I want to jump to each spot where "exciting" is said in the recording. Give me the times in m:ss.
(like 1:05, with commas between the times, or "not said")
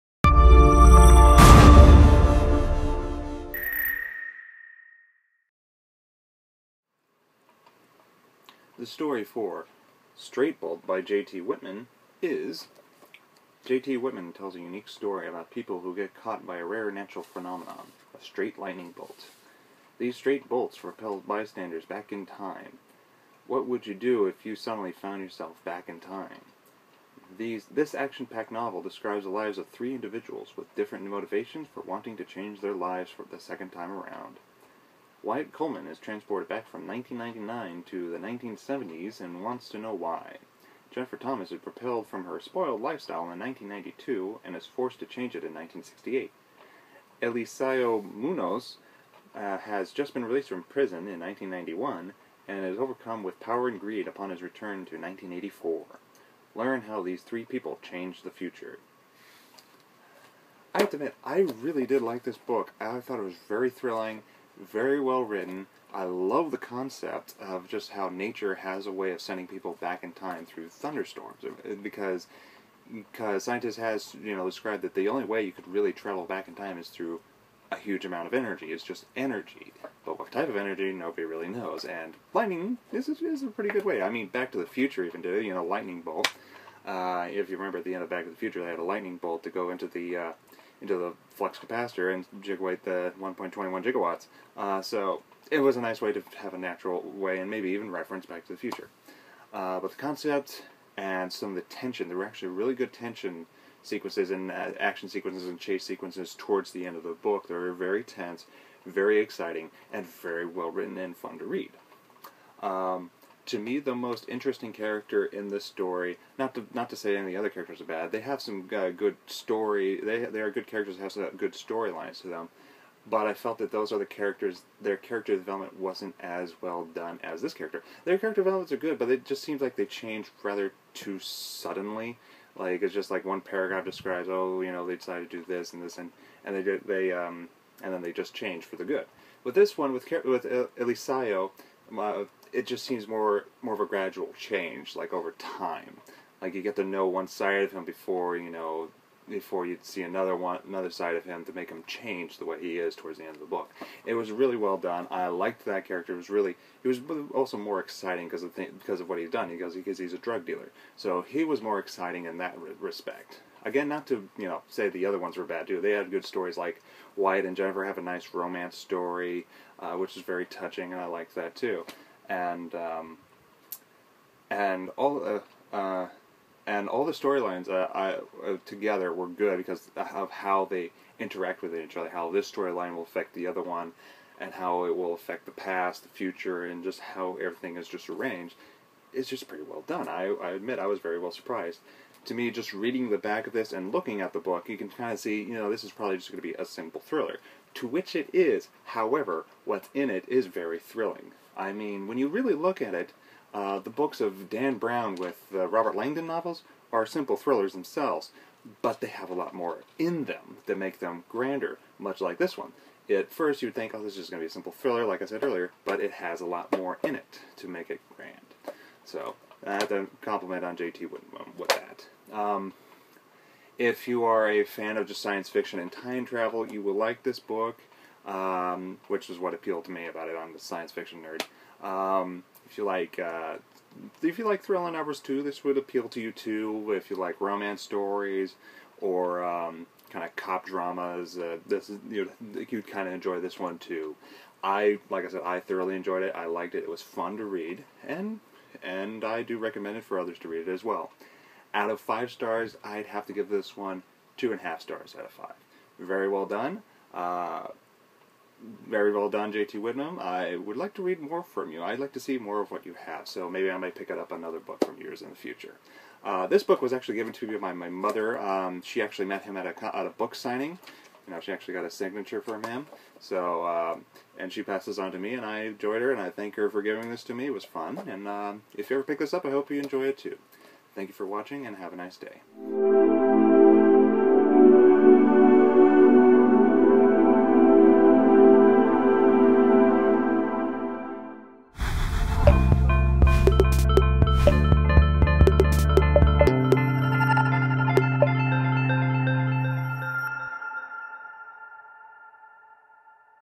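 1:49, 2:37, 2:41.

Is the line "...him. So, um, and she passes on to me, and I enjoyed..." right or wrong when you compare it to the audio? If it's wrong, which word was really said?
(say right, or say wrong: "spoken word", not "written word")
right.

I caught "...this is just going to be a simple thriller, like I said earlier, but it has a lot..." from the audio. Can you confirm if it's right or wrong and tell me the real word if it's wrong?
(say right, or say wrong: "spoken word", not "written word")
right.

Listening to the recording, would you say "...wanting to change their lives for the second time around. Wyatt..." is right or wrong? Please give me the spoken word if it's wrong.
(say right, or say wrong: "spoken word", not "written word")
right.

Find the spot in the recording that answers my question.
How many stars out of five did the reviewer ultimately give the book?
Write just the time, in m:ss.
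4:14.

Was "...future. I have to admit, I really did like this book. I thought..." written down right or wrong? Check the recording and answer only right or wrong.
right.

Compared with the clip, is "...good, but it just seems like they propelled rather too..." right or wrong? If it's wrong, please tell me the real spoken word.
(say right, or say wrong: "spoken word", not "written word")
wrong: "changed", not "propelled".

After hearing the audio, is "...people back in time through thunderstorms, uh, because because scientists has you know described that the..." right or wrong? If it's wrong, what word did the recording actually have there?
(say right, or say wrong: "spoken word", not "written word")
right.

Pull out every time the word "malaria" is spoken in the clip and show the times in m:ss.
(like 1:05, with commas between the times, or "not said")
not said.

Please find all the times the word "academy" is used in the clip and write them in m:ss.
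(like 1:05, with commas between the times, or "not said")
not said.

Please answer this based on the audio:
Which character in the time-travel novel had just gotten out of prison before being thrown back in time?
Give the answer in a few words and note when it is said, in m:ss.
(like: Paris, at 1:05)
Eliseo Munoz, at 0:47.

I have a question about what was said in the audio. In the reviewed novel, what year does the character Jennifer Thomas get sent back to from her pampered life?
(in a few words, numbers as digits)
1968.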